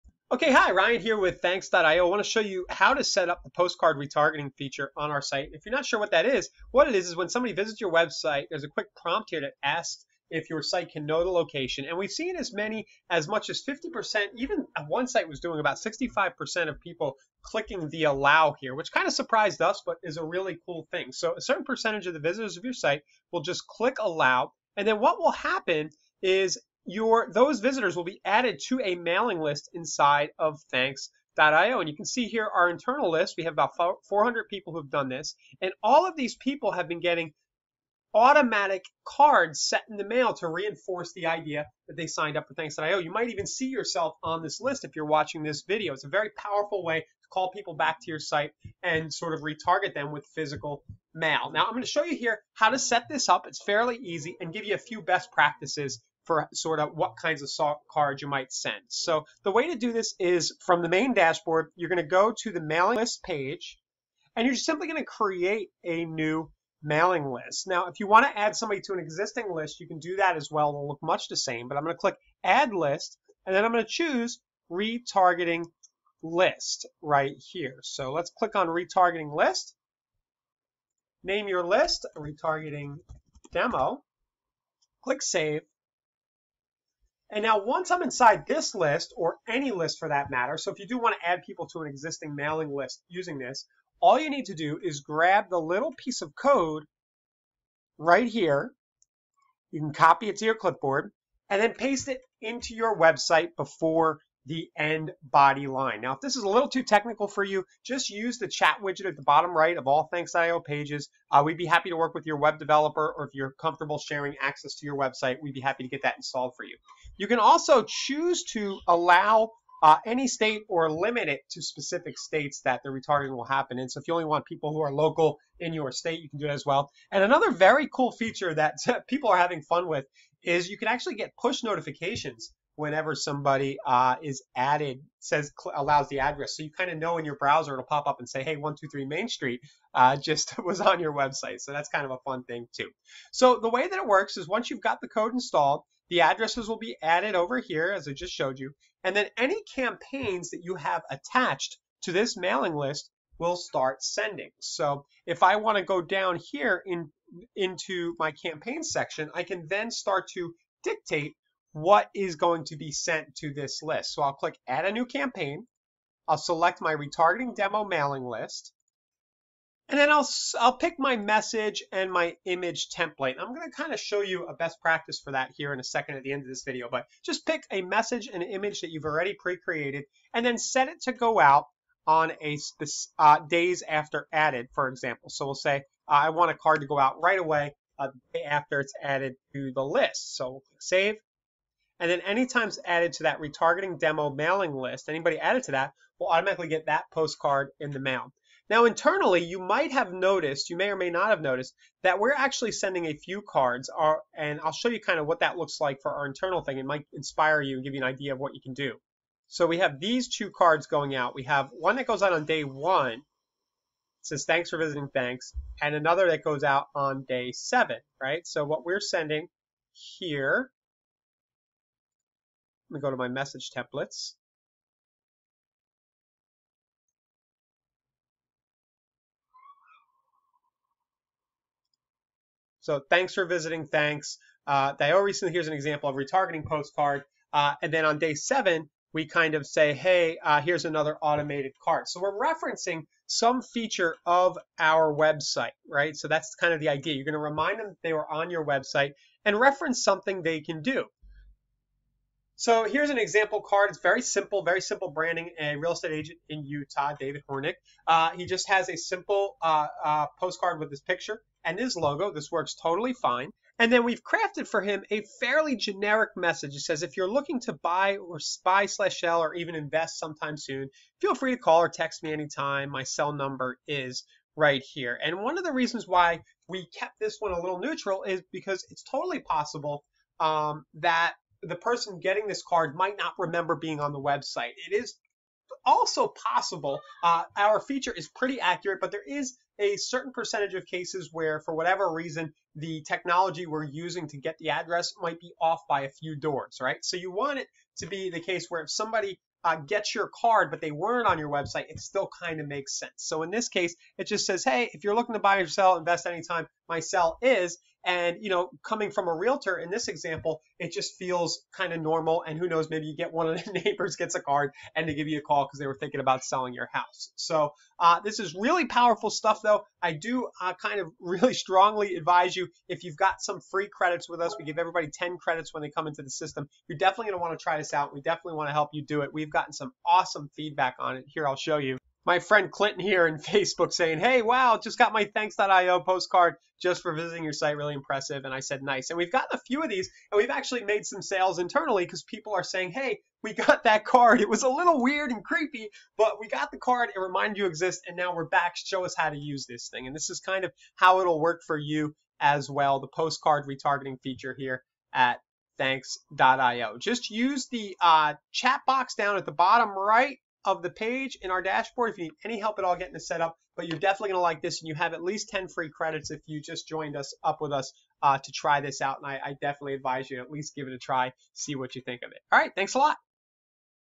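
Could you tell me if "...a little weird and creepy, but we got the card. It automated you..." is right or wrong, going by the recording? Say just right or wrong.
wrong.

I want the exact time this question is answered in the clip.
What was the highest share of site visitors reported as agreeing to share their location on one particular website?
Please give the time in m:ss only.
0:15.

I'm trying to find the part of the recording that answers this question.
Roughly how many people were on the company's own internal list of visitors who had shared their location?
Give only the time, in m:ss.
0:34.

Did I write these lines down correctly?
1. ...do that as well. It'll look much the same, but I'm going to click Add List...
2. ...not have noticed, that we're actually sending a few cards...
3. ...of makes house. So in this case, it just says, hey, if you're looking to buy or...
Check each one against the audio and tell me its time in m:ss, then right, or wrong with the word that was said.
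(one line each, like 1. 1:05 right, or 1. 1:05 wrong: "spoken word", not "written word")
1. 1:09 right
2. 3:21 right
3. 5:02 wrong: "sense", not "house".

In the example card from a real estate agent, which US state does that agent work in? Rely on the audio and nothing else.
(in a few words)
Utah.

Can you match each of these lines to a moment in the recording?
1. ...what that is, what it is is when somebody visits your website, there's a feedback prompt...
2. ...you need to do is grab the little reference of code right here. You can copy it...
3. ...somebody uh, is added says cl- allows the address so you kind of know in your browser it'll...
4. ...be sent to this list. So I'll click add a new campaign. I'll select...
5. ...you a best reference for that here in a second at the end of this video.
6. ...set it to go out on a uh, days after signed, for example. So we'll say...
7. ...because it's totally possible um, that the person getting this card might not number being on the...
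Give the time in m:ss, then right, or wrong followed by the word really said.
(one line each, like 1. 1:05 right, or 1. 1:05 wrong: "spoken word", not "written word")
1. 0:05 wrong: "quick", not "feedback"
2. 1:34 wrong: "piece", not "reference"
3. 2:13 right
4. 2:42 right
5. 2:54 wrong: "practice", not "reference"
6. 3:00 wrong: "added", not "signed"
7. 4:38 wrong: "remember", not "number".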